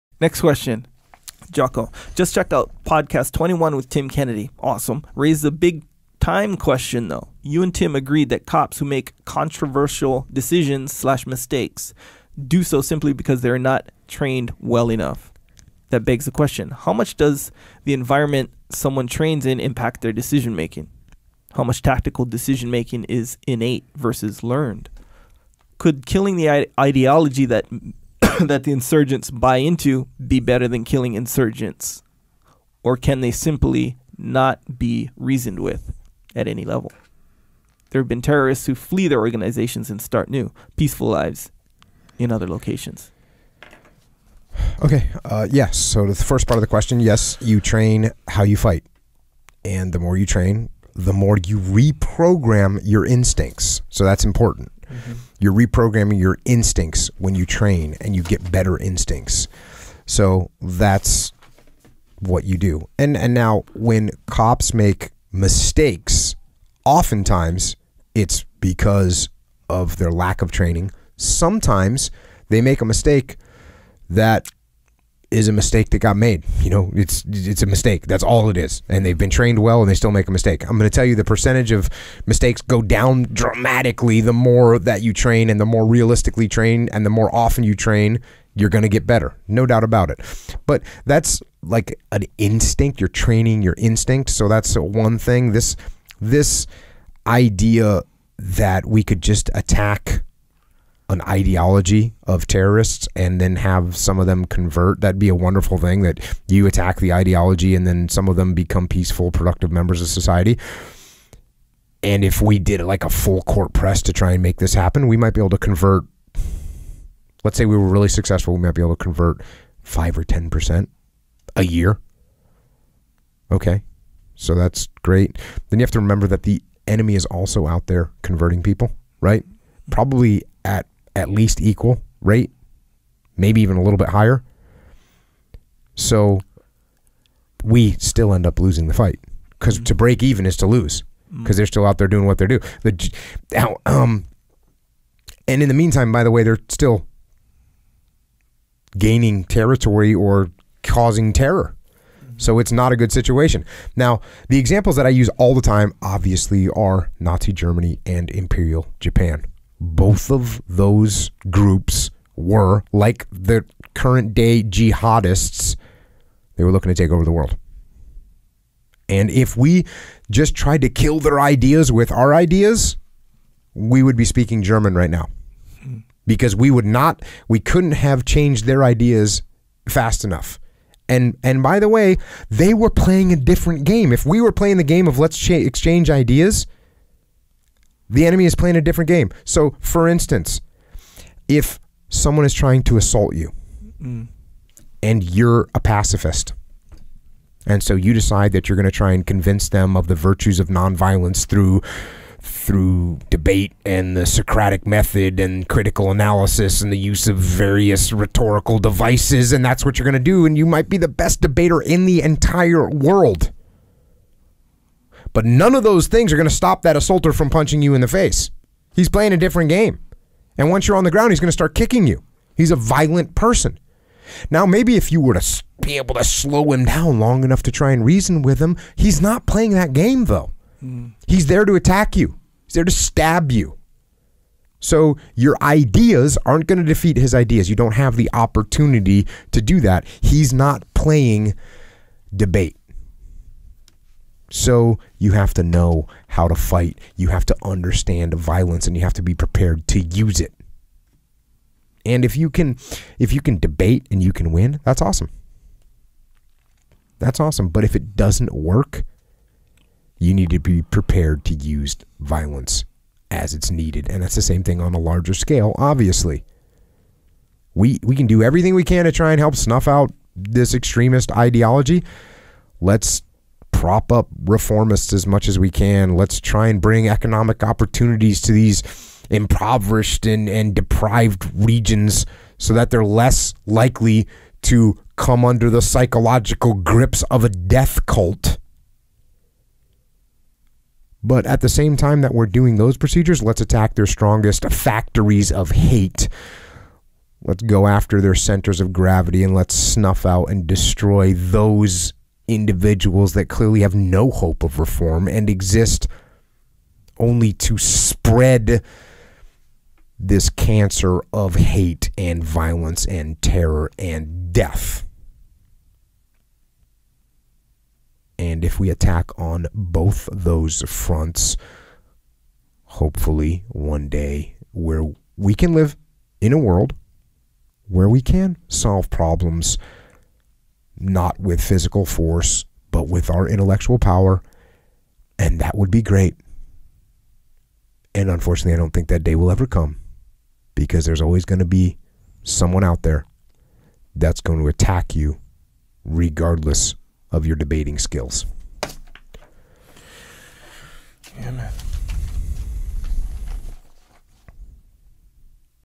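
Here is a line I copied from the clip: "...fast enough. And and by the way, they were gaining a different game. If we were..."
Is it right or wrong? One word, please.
wrong.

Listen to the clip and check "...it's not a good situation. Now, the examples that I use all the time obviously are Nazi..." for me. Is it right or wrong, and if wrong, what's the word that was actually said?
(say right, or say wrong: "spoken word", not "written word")
right.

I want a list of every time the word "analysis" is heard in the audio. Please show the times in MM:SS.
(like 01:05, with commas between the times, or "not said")
03:26.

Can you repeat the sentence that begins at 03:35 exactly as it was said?
But none of those things are going to stop that assaulter from punching you in the face.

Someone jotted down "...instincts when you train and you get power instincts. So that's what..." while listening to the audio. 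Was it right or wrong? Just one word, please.
wrong.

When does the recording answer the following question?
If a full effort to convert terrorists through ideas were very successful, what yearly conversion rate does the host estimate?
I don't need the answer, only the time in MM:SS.
01:59.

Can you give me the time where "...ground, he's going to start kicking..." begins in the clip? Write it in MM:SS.
03:41.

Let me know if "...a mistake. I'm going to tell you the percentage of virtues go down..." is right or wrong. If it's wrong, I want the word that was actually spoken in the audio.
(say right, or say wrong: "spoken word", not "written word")
wrong: "mistakes", not "virtues".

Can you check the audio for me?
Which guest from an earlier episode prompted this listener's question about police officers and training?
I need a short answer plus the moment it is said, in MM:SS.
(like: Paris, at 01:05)
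Tim Kennedy, at 00:03.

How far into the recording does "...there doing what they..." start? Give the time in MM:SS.
02:21.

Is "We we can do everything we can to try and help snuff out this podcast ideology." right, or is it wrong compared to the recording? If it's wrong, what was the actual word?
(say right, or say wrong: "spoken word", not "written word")
wrong: "extremist", not "podcast".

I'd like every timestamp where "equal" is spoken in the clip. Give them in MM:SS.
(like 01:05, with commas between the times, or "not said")
02:11.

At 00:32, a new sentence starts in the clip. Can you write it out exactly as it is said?
Or can they simply not be reasoned with at any level?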